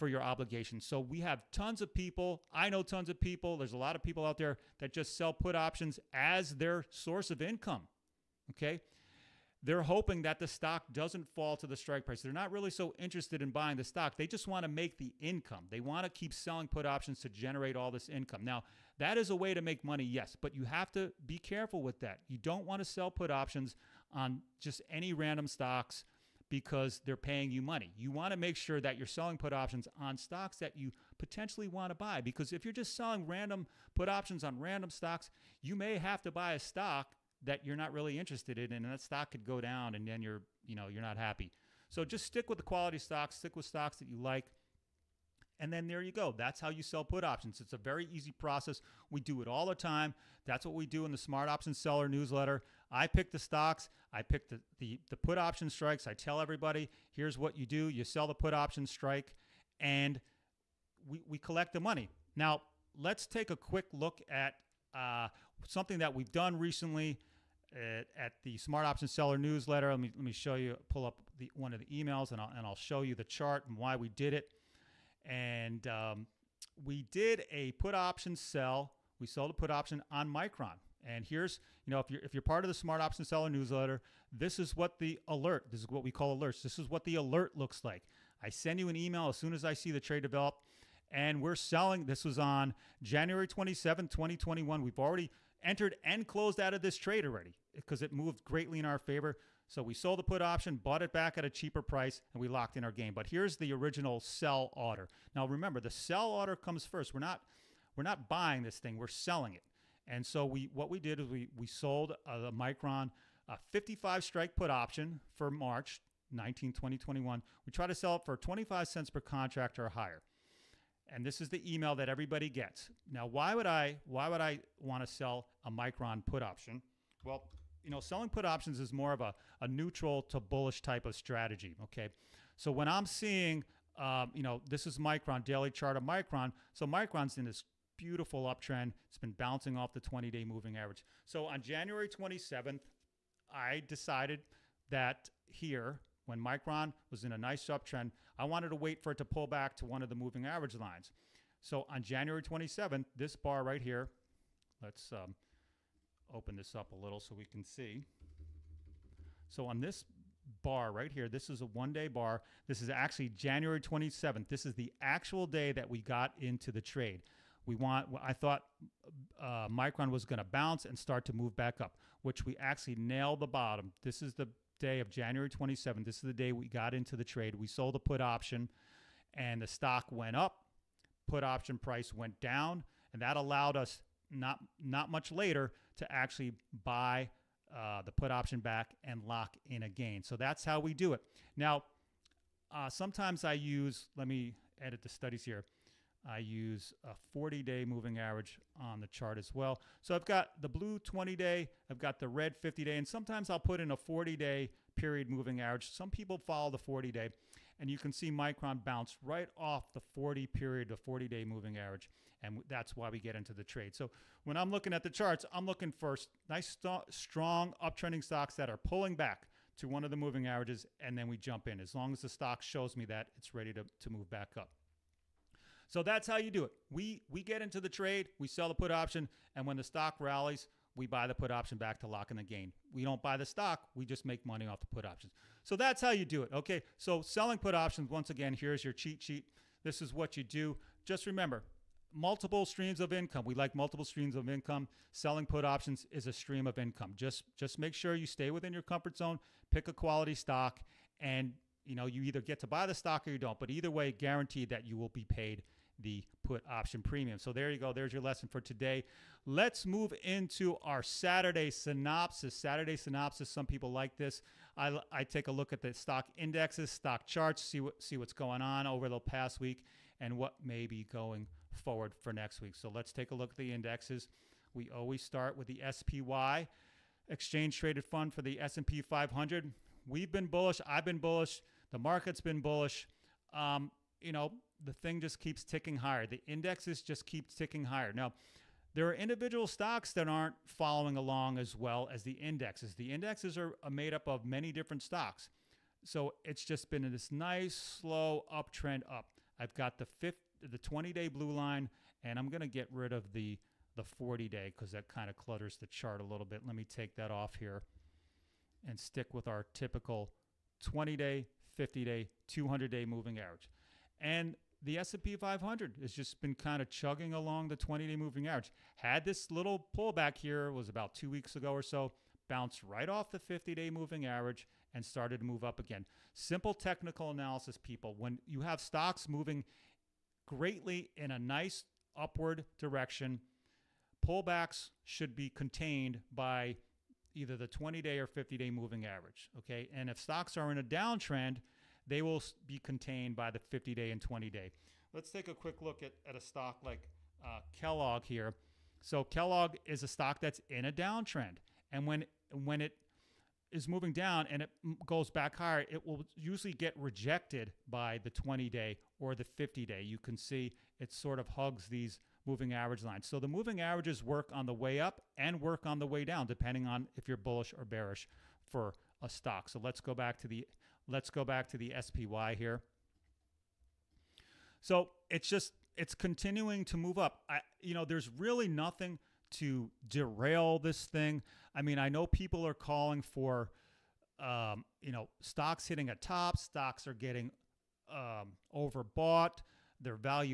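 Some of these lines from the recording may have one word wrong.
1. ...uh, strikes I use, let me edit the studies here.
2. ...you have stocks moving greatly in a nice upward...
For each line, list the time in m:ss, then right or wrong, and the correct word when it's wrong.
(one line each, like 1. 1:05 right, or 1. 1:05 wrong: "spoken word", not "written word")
1. 3:12 wrong: "sometimes", not "strikes"
2. 5:28 right.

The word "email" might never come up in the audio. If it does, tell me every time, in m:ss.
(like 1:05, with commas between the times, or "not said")
1:11, 1:28, 2:01.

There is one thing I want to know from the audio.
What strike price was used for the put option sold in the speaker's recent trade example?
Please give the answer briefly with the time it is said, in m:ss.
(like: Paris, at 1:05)
55, at 1:53.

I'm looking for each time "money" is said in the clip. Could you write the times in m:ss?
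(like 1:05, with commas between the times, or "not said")
0:19, 0:27, 1:01, 3:54.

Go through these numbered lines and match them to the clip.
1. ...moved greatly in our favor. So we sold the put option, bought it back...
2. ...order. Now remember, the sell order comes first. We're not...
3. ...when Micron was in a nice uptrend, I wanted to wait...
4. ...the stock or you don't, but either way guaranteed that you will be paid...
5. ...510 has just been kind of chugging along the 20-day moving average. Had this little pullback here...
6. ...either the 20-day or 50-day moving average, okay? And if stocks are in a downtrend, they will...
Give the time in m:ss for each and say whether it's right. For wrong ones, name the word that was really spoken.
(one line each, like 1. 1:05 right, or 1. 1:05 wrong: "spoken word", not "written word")
1. 1:38 right
2. 1:44 right
3. 2:26 right
4. 4:12 right
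5. 5:15 wrong: "500", not "510"
6. 5:37 right.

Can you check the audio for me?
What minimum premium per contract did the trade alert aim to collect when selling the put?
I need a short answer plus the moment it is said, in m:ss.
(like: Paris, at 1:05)
25 cents, at 1:58.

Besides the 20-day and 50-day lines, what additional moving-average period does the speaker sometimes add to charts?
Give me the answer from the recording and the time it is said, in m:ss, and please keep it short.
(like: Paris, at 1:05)
40 day, at 3:23.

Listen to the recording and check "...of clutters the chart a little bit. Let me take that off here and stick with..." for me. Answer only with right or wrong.
right.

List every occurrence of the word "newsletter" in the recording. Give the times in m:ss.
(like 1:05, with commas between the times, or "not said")
0:52, 1:09, 1:23.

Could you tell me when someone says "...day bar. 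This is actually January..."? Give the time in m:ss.
2:41.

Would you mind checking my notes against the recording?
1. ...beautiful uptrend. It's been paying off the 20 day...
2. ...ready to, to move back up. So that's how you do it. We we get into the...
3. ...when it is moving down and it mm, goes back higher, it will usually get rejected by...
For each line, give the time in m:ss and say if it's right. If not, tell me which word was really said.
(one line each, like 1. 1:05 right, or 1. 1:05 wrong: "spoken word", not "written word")
1. 2:17 wrong: "bouncing", not "paying"
2. 3:43 right
3. 5:52 right.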